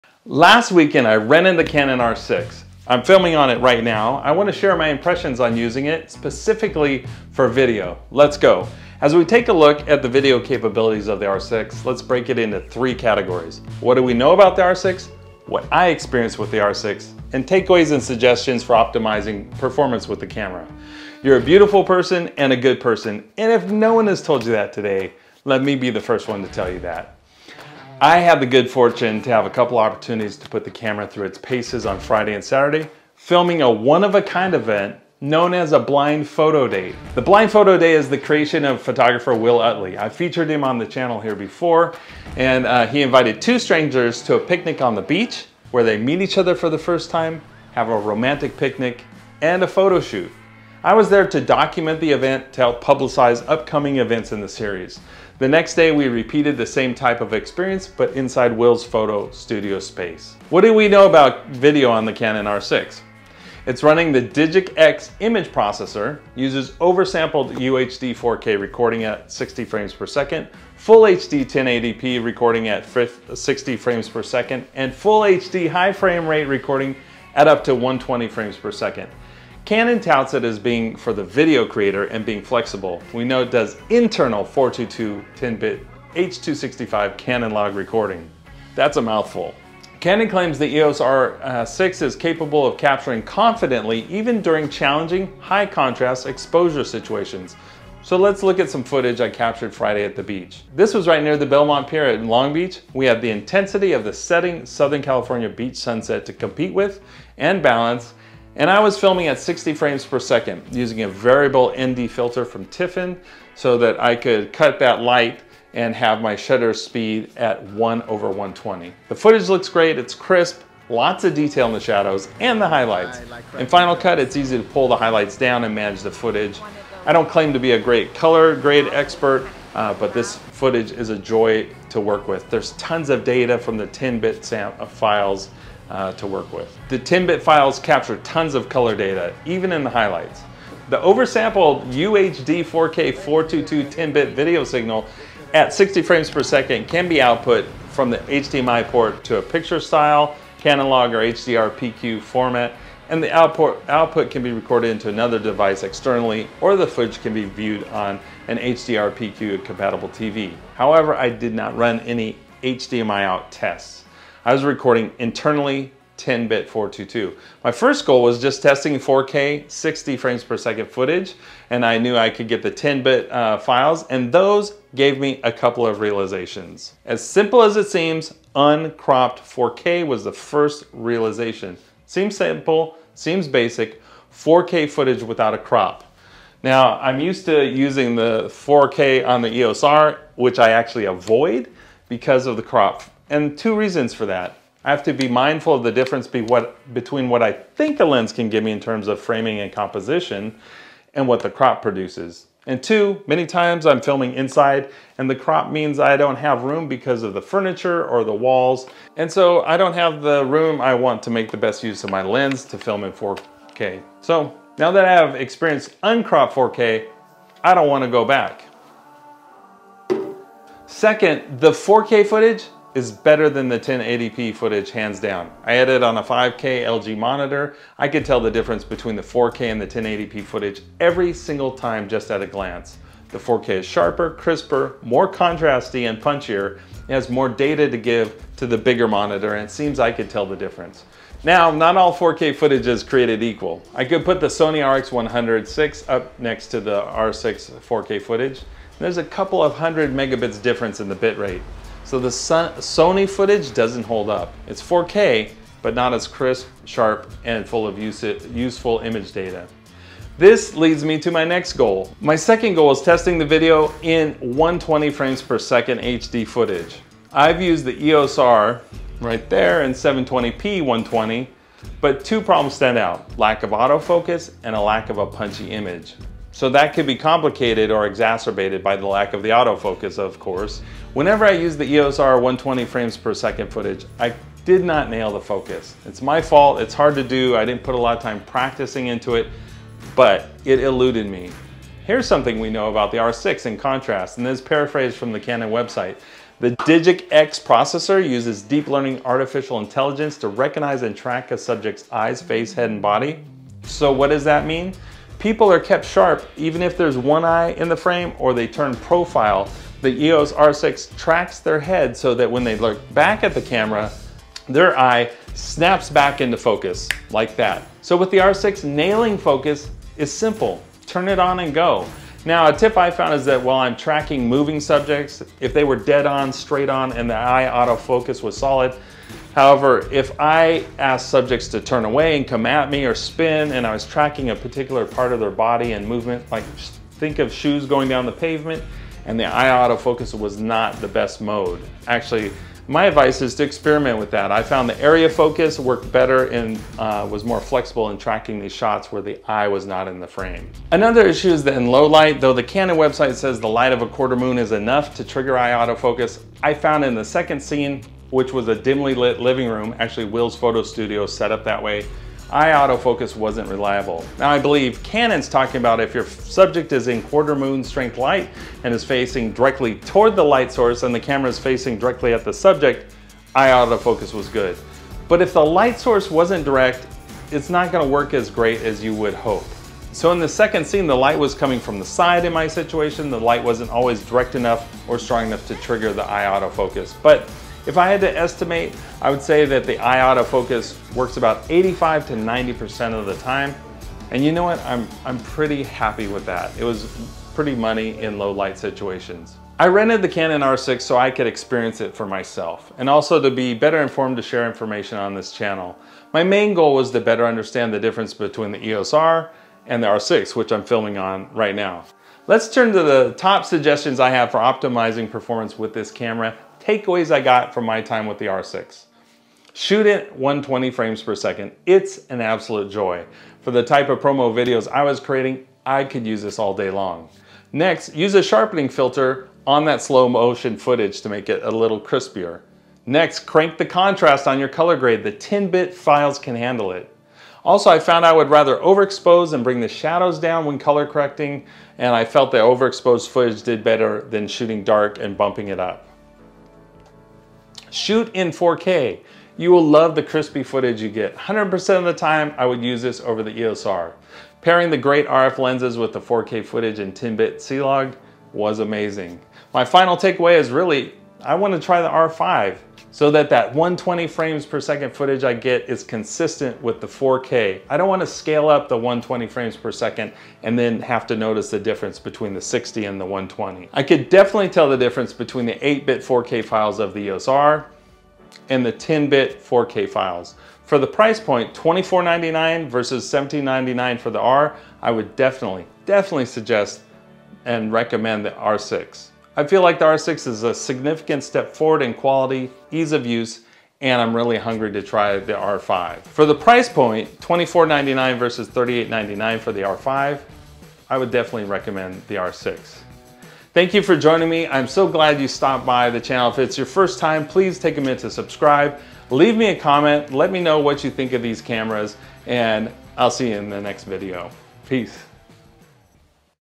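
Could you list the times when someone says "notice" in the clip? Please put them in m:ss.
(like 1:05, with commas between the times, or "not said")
7:51.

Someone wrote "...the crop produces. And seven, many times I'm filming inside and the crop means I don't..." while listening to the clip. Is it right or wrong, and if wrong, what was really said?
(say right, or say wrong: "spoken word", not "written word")
wrong: "two", not "seven".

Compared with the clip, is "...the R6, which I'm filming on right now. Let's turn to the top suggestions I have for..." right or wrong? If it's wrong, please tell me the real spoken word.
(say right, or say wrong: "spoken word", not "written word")
right.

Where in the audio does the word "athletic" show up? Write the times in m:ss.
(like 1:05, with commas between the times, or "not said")
not said.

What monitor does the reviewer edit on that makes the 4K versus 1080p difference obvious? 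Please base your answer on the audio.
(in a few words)
5K LG.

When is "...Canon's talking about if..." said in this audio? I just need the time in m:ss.
6:05.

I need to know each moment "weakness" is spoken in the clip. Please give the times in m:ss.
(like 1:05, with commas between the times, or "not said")
not said.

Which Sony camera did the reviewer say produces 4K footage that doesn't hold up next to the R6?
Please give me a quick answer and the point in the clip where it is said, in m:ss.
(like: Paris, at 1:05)
Sony RX106, at 4:04.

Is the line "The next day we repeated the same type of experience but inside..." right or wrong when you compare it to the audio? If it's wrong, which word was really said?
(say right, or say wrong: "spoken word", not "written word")
right.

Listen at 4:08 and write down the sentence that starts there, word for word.
There's a couple of hundred megabits difference in the bitrate.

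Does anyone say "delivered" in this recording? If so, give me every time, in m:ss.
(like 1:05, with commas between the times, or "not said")
not said.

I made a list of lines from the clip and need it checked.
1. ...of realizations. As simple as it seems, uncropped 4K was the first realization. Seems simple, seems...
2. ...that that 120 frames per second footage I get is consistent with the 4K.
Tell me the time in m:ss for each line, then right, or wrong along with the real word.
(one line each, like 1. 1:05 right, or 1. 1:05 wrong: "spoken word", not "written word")
1. 2:55 right
2. 7:43 right.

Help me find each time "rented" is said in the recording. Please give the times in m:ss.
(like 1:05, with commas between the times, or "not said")
0:01, 6:39.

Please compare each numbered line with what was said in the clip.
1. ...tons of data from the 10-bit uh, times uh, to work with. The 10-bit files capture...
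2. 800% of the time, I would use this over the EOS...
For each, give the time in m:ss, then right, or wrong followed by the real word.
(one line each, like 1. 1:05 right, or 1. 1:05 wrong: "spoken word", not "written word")
1. 2:12 wrong: "files", not "times"
2. 7:31 wrong: "100", not "800".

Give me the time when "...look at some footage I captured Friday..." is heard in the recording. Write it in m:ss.
1:38.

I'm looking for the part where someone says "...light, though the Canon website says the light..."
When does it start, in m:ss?
5:52.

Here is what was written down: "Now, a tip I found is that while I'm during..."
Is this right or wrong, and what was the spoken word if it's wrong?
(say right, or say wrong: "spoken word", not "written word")
wrong: "tracking", not "during".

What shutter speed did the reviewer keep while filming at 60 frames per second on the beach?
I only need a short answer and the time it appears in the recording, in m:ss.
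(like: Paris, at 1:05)
1/120, at 1:57.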